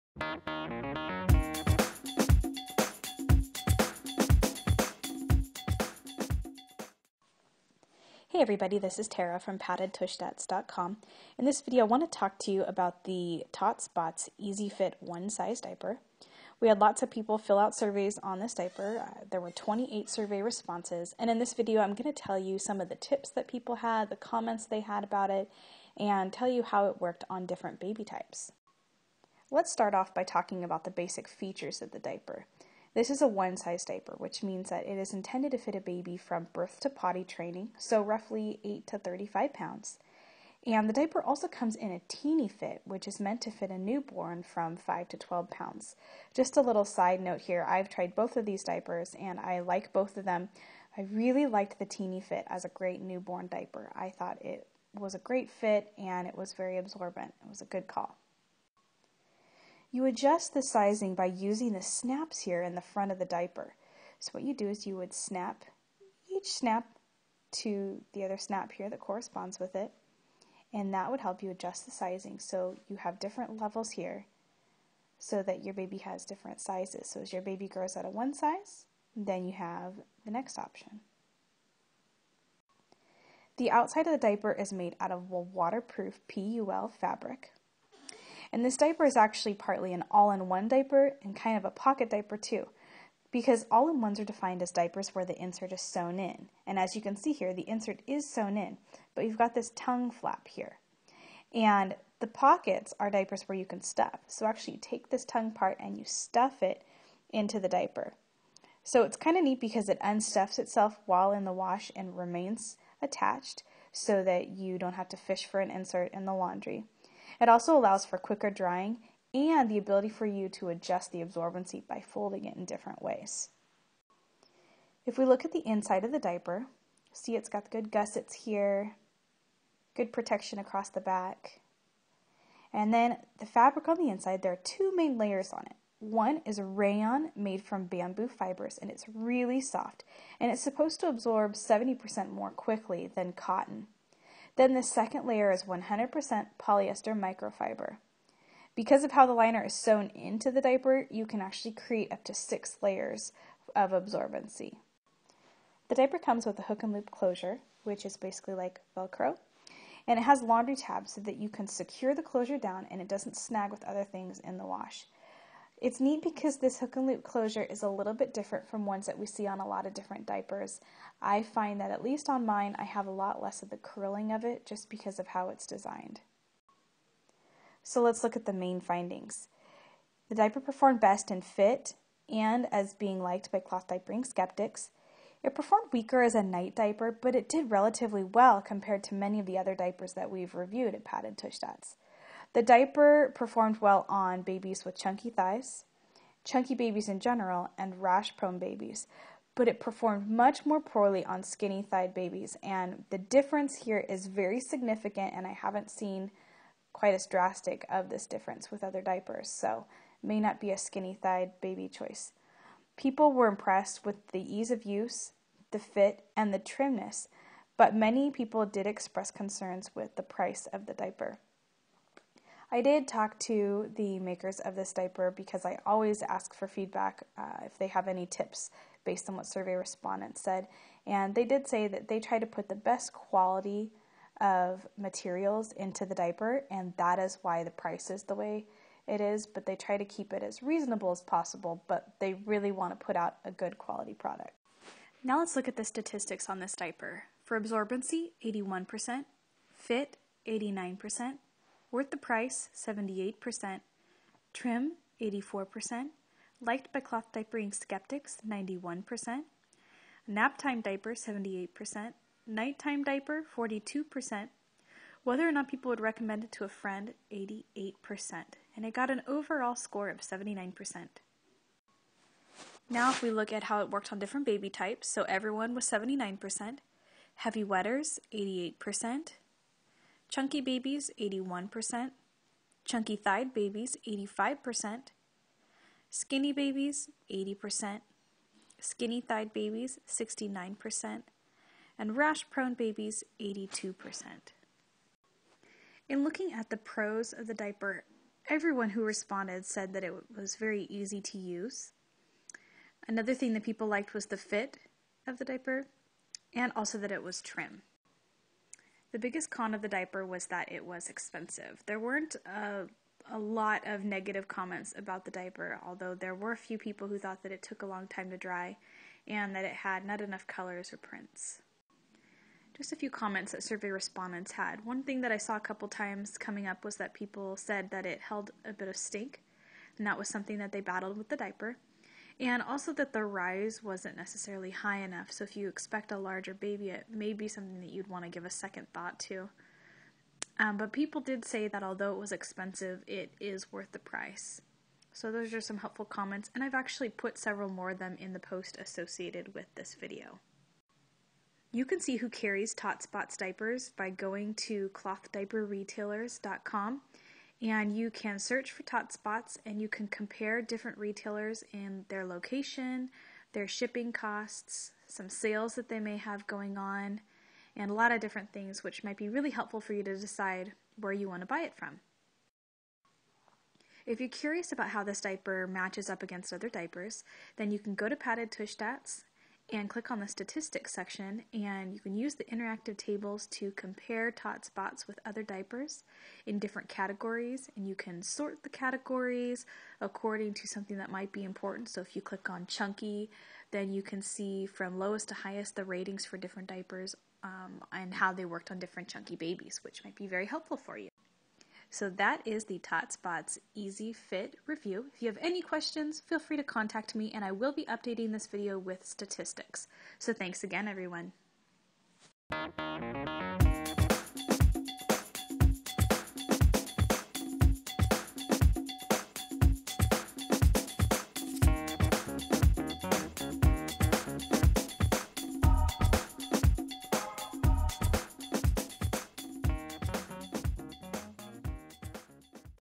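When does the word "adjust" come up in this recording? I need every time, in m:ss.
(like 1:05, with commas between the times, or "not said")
1:00, 1:11, 2:00.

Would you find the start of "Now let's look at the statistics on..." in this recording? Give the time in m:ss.
4:05.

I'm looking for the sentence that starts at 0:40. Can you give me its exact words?
And the diaper also comes in a teeny fit, which is meant to fit a newborn from 5 to 12 pounds.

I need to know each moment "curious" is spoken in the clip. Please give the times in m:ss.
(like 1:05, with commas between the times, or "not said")
6:14.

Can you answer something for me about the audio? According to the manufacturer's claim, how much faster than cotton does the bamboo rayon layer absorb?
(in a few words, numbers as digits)
70%.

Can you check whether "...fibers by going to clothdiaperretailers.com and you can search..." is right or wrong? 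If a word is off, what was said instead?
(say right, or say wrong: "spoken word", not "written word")
wrong: "diapers", not "fibers".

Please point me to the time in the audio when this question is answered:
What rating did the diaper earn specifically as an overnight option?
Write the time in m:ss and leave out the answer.
4:23.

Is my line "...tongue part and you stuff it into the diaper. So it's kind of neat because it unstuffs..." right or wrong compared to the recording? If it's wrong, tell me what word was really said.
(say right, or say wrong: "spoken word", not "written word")
right.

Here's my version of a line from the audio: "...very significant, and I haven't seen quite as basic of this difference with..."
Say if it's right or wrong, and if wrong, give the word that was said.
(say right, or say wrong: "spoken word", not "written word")
wrong: "drastic", not "basic".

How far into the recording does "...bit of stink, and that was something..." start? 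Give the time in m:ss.
5:28.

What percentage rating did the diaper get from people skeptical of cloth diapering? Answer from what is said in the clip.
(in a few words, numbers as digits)
91%.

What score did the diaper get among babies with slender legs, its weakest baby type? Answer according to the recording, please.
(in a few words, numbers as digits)
69%.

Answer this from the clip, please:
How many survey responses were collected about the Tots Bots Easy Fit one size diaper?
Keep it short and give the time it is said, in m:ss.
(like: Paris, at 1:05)
28, at 0:19.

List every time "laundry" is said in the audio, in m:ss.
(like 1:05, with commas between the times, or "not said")
1:56, 2:40.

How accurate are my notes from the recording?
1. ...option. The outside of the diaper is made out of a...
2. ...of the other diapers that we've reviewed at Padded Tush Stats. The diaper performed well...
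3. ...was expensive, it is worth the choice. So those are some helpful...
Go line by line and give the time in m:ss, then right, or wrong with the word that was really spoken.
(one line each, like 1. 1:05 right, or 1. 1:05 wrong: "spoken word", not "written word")
1. 1:20 right
2. 3:09 right
3. 5:42 wrong: "price", not "choice".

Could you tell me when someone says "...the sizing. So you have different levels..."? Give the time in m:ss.
1:11.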